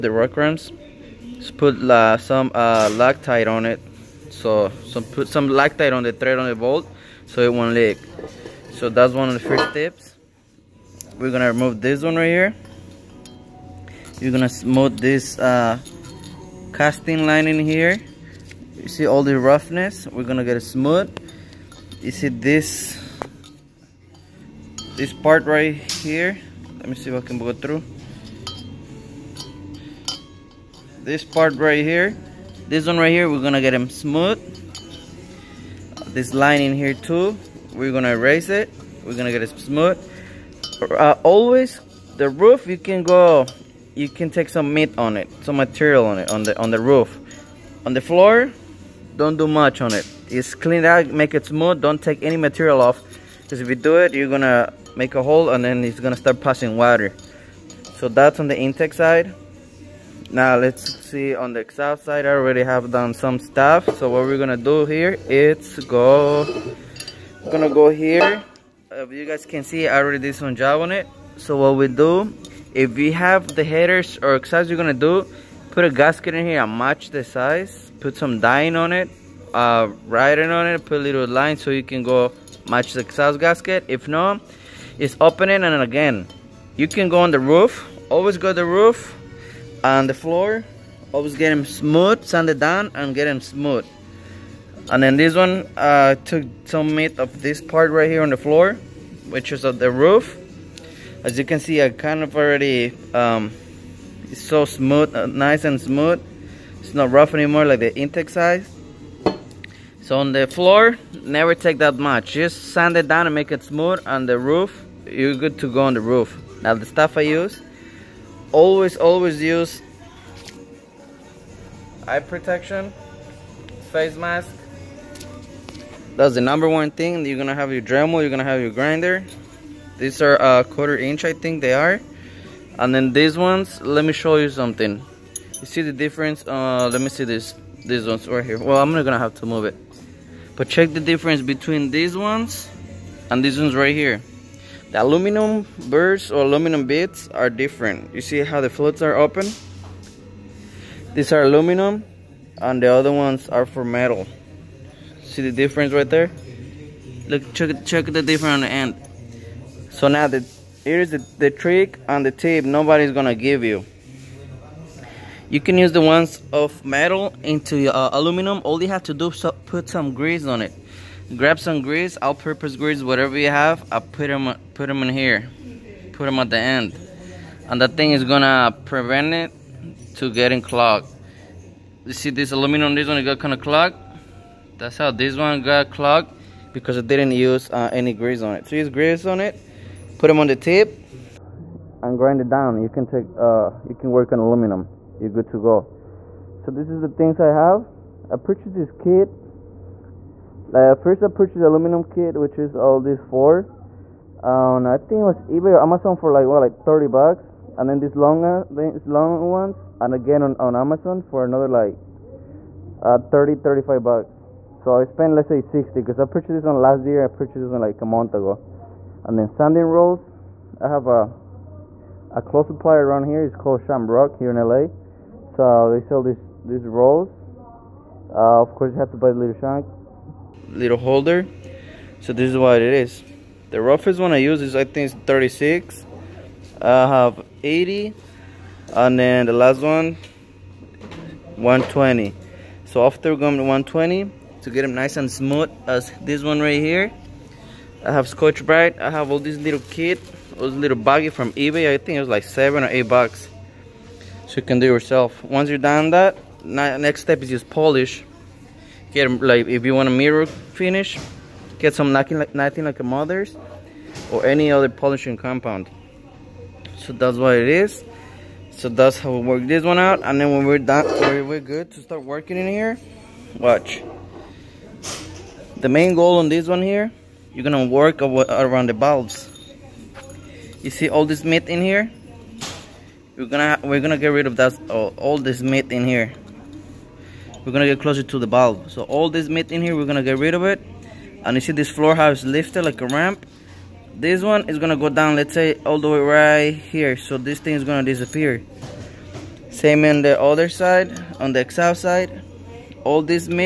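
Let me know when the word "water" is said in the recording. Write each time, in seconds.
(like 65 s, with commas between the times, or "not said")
56 s.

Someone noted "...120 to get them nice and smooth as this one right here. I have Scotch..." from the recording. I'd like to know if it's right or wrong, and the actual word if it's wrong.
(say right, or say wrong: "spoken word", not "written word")
right.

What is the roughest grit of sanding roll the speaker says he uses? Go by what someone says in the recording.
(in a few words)
36.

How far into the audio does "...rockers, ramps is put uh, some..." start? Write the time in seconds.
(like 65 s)
0 s.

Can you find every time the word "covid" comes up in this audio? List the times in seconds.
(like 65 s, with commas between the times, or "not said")
not said.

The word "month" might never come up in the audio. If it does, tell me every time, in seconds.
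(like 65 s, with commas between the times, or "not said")
218 s.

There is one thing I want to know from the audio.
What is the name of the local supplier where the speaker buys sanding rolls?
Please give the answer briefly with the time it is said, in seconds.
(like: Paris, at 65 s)
Shamrock, at 223 s.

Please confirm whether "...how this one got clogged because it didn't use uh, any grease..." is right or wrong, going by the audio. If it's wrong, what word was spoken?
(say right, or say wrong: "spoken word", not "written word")
right.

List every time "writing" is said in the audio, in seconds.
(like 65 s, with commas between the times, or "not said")
80 s.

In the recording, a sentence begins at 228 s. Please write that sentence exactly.
Uh, of course you have to buy the little shank, little holder.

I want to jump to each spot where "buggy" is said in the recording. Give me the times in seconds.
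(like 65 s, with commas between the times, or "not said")
250 s.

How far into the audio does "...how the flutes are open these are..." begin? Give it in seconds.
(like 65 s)
148 s.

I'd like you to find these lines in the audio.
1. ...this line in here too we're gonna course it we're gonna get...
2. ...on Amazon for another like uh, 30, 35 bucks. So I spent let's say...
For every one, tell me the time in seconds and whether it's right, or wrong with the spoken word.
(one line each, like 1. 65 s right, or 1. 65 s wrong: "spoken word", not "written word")
1. 36 s wrong: "erase", not "course"
2. 210 s right.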